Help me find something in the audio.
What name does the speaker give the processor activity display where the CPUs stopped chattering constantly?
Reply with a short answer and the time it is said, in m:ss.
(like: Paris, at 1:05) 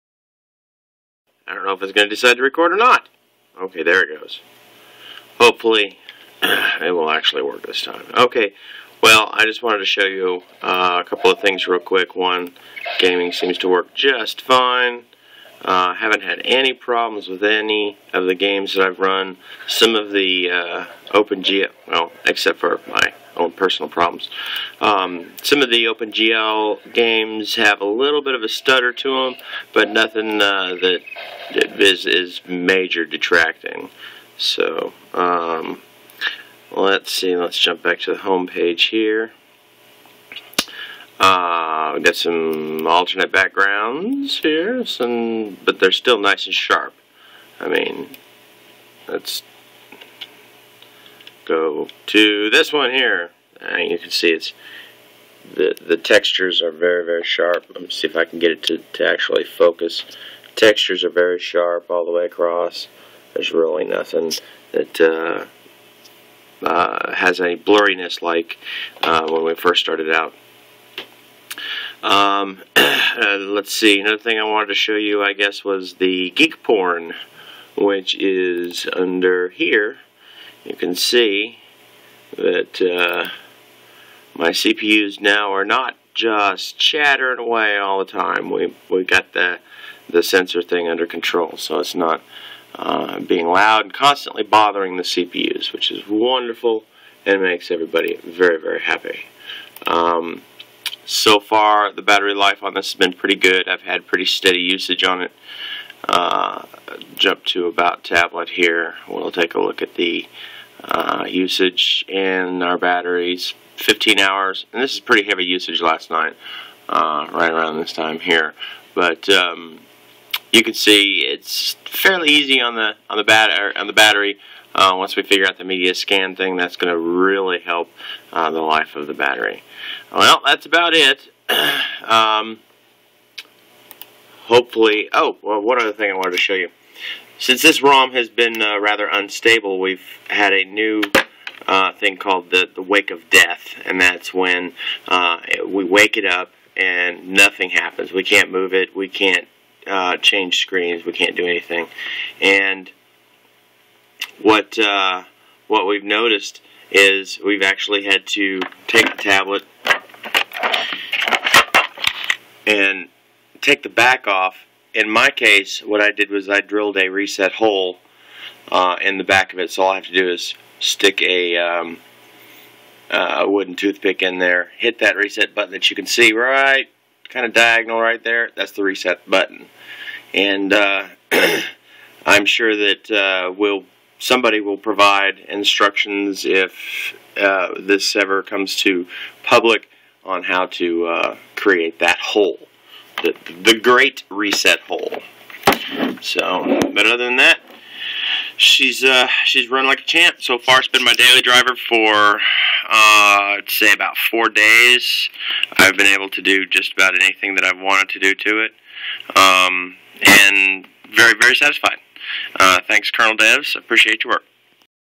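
Geek Porn, at 1:16.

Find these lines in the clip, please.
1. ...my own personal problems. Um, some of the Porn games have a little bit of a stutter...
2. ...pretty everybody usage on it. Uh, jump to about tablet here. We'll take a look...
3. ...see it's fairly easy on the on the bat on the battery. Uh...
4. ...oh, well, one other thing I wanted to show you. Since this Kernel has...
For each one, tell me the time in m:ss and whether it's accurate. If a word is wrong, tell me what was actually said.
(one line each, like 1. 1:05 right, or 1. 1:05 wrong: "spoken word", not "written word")
1. 0:22 wrong: "OpenGL", not "Porn"
2. 1:44 wrong: "steady", not "everybody"
3. 2:00 right
4. 2:15 wrong: "ROM", not "Kernel".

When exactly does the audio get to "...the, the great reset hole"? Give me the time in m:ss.
3:13.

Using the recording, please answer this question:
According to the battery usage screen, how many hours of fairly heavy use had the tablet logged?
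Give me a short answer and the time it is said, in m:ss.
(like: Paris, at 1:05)
15 hours, at 1:53.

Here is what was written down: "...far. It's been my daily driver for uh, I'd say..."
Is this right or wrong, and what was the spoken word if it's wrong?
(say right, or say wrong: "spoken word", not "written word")
right.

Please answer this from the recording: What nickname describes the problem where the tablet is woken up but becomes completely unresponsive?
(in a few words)
wake of death.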